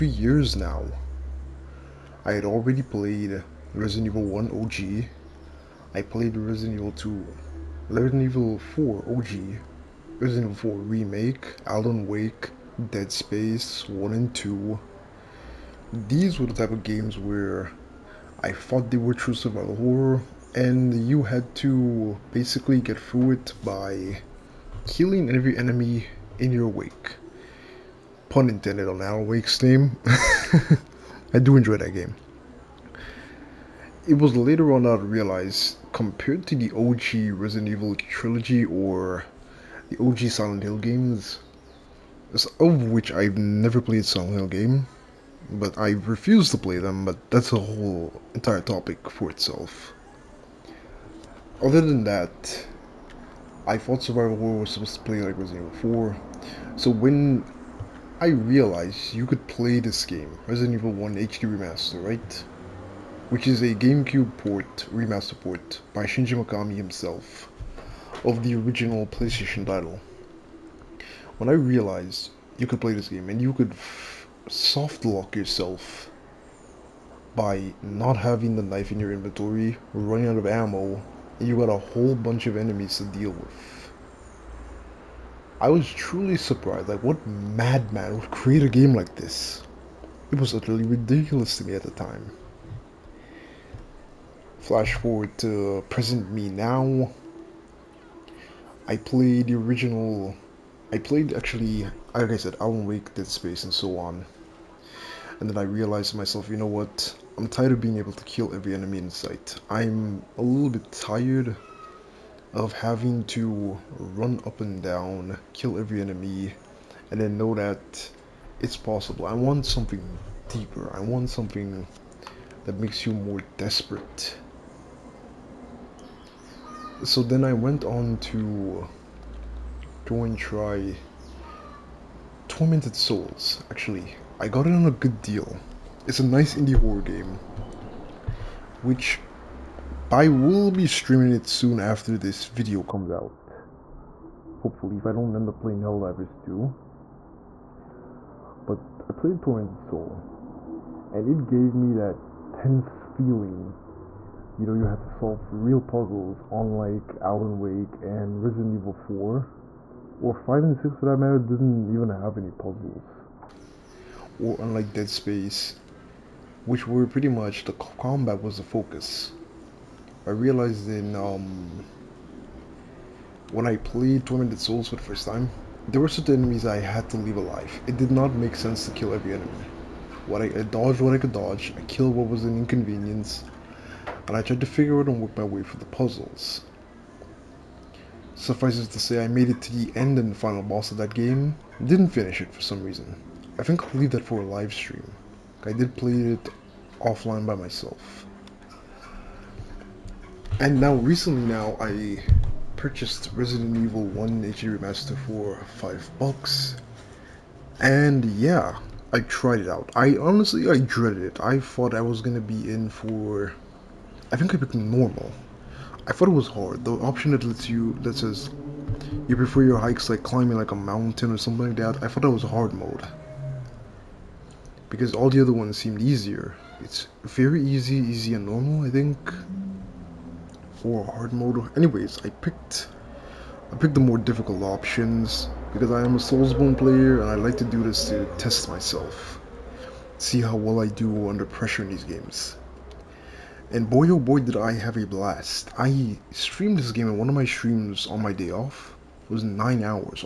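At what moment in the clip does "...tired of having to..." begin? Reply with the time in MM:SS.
01:50.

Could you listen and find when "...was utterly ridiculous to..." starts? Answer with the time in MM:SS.
01:30.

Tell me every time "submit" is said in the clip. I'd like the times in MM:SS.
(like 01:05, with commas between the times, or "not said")
not said.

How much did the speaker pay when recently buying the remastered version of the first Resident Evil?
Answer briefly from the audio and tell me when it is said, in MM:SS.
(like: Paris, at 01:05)
5 bucks, at 03:25.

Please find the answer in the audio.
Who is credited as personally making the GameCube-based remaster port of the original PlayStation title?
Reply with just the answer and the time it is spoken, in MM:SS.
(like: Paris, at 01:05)
Shinji Mikami, at 01:06.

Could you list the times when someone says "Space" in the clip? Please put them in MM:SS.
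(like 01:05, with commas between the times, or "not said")
00:13, 01:43, 02:45.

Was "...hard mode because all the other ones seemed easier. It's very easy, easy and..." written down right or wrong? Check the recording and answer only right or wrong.
right.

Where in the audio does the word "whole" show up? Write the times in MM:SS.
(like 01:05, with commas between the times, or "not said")
00:47, 01:21.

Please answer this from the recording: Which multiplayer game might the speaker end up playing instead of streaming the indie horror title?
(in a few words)
Helldivers 2.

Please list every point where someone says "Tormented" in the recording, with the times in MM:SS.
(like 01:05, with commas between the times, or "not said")
02:12, 02:29, 02:54.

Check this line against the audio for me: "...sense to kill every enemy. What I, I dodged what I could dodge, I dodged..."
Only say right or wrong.
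wrong.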